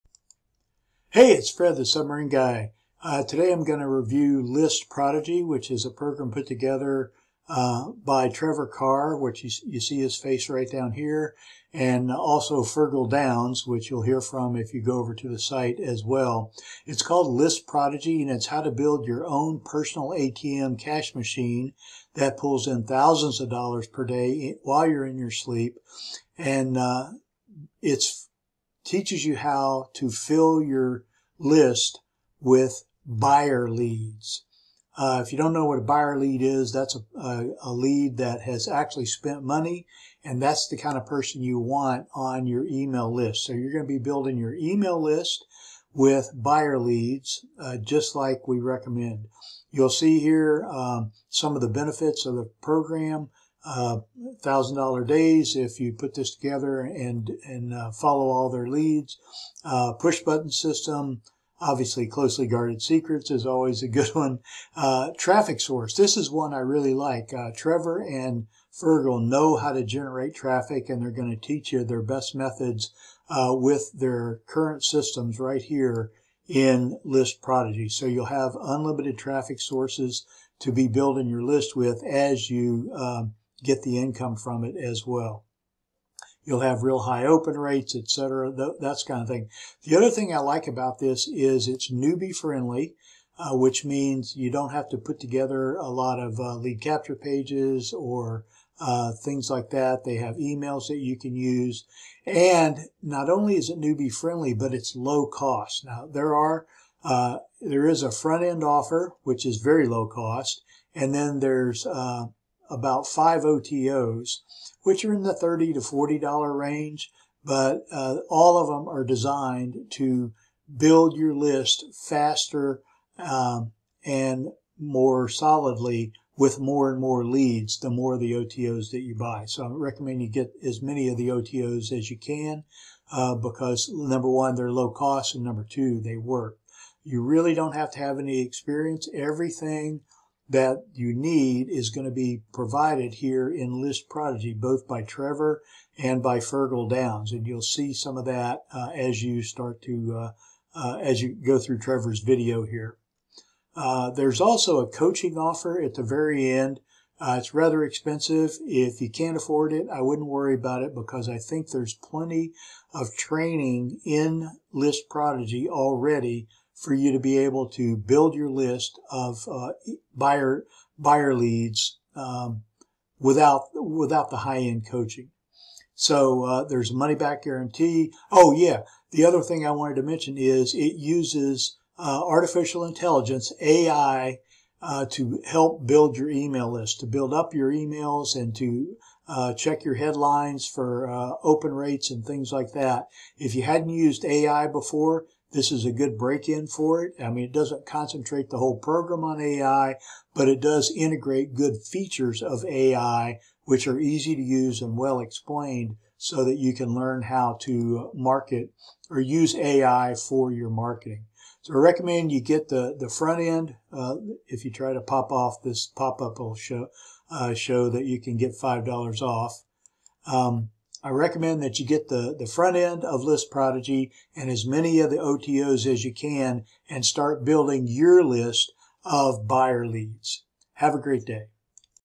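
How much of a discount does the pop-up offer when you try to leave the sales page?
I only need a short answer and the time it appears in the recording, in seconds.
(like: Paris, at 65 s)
$5, at 218 s.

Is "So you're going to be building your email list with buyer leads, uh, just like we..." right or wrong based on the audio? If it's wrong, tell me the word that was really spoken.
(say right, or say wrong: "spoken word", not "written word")
right.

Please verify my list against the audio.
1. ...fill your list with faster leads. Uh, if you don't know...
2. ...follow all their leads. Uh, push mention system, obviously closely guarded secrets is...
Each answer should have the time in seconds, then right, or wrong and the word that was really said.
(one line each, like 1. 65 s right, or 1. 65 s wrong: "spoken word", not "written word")
1. 30 s wrong: "buyer", not "faster"
2. 57 s wrong: "button", not "mention".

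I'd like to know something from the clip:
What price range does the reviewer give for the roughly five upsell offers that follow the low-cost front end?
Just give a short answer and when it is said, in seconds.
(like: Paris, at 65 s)
$30 to $40, at 115 s.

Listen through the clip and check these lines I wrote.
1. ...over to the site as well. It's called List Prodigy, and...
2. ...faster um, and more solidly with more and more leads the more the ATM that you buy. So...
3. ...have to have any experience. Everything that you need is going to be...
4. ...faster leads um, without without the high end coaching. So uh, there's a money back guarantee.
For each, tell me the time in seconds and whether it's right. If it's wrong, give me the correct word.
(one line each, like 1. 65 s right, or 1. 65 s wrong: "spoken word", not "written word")
1. 14 s right
2. 122 s wrong: "OTOs", not "ATM"
3. 137 s right
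4. 170 s wrong: "buyer", not "faster".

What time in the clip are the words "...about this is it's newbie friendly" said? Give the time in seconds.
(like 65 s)
90 s.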